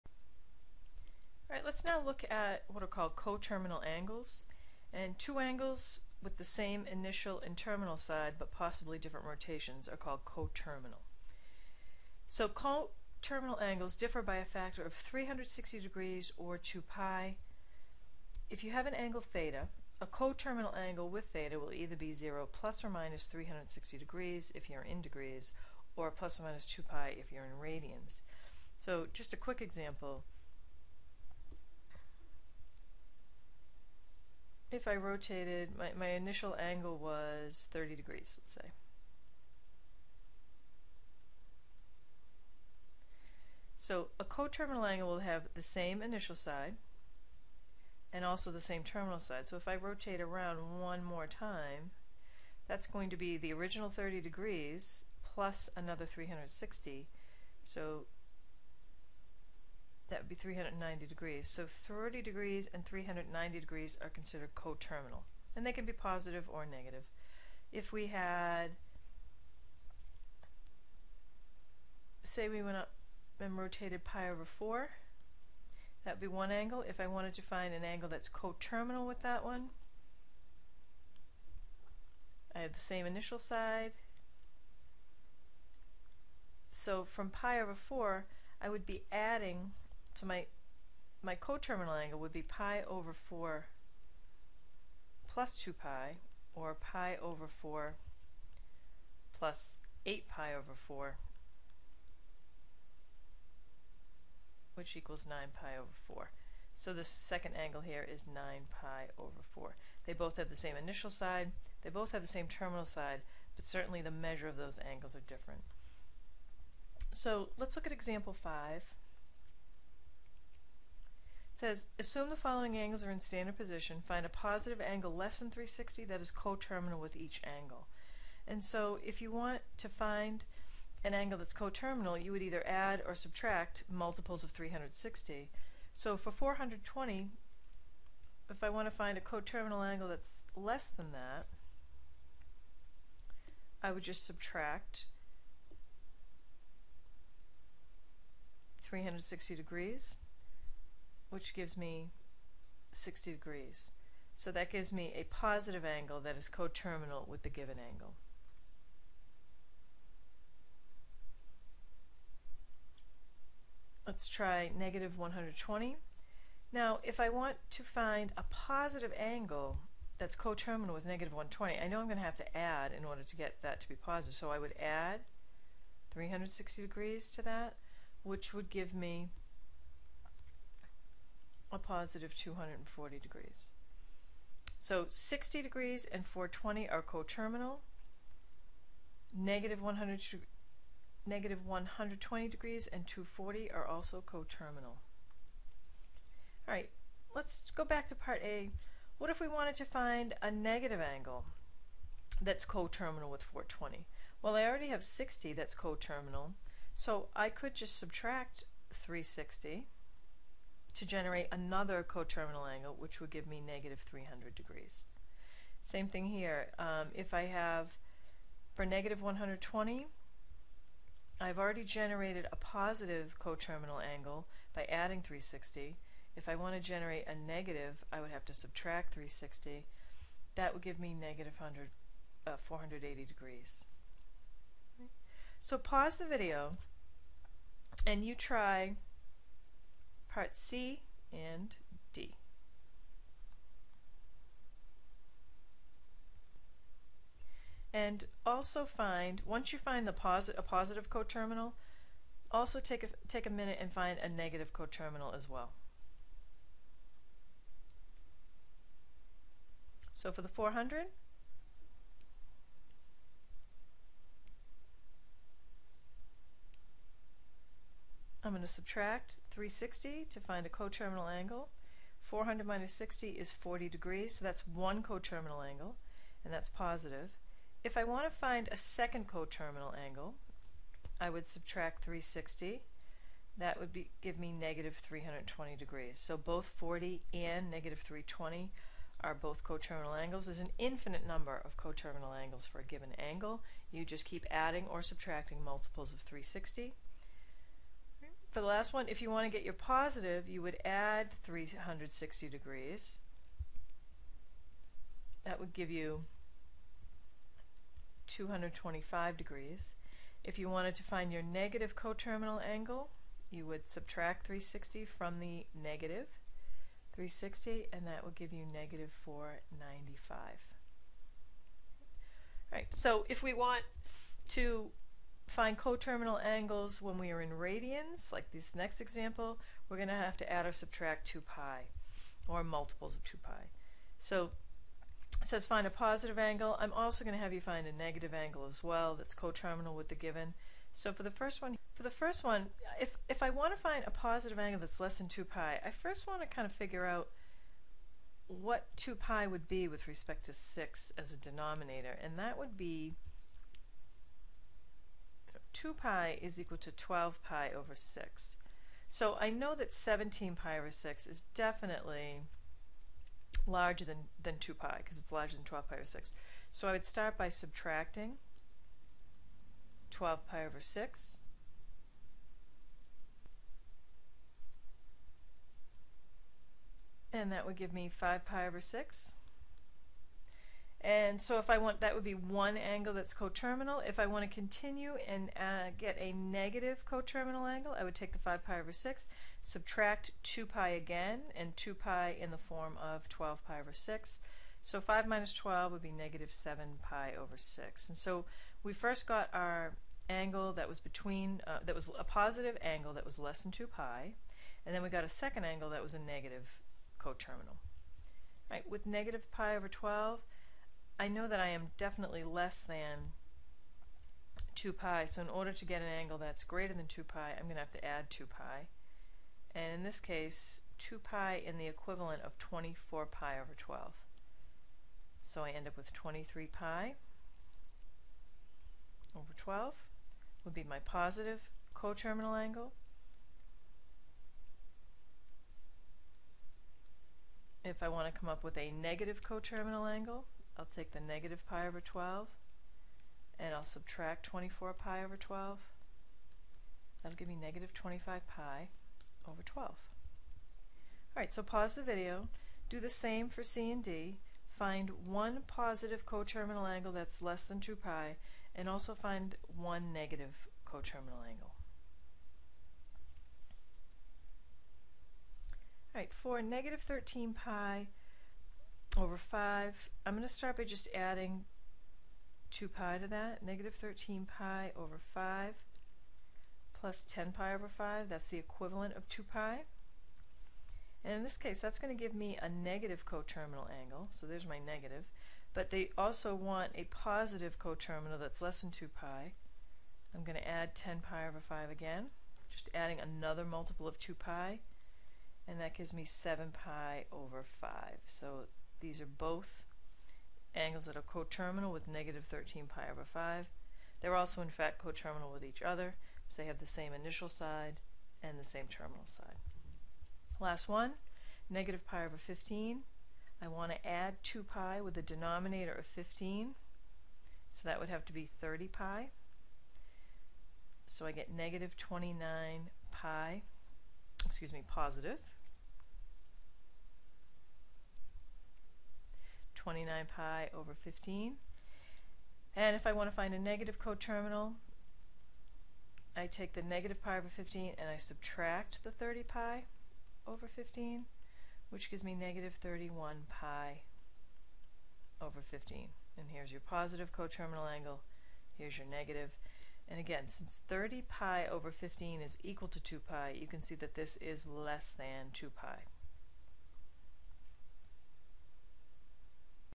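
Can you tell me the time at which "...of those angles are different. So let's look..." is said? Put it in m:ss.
1:54.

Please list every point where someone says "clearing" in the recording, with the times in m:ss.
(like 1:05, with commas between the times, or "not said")
not said.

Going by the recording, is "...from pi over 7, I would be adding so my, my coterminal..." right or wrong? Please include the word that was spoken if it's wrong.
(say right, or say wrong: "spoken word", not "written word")
wrong: "4", not "7".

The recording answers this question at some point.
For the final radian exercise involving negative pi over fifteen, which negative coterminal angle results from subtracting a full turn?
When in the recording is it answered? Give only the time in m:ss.
9:02.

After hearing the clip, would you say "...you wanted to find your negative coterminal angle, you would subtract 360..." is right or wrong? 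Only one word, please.
right.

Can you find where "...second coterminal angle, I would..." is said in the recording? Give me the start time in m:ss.
4:38.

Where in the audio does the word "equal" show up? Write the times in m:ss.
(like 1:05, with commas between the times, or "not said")
1:44, 5:56, 9:12.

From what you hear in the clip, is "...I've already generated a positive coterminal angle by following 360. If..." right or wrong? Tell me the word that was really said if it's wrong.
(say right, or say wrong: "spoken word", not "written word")
wrong: "adding", not "following".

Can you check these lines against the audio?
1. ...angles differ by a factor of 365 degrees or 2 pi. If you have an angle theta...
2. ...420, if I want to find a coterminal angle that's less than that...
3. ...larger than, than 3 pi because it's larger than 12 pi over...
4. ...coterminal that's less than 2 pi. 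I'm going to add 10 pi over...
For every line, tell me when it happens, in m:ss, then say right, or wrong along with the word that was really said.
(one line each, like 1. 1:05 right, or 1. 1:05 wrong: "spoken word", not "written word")
1. 0:13 wrong: "360", not "365"
2. 2:16 right
3. 6:03 wrong: "2", not "3"
4. 8:07 right.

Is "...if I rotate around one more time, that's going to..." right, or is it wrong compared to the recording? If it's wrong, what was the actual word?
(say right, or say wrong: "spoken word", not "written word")
right.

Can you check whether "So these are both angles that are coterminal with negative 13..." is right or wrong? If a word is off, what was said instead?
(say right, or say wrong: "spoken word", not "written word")
right.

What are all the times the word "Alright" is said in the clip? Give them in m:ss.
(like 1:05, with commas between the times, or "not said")
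7:31, 7:46.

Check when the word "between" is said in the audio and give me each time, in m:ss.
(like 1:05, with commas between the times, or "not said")
6:40.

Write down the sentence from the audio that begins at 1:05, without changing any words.
And they can be positive or negative.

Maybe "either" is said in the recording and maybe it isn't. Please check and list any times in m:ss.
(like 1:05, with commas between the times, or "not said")
0:21, 2:12.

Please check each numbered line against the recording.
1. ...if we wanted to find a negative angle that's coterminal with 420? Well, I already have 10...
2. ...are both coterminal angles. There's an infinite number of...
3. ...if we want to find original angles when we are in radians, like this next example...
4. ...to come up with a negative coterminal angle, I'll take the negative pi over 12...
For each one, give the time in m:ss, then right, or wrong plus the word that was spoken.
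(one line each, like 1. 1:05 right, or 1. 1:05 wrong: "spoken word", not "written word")
1. 3:19 wrong: "60", not "10"
2. 4:49 right
3. 5:23 wrong: "coterminal", not "original"
4. 7:18 right.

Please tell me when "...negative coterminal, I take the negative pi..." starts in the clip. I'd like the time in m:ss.
8:53.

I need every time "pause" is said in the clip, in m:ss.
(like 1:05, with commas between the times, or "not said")
3:55, 7:31.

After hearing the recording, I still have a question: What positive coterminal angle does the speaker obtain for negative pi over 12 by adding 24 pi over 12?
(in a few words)
23 pi over 12.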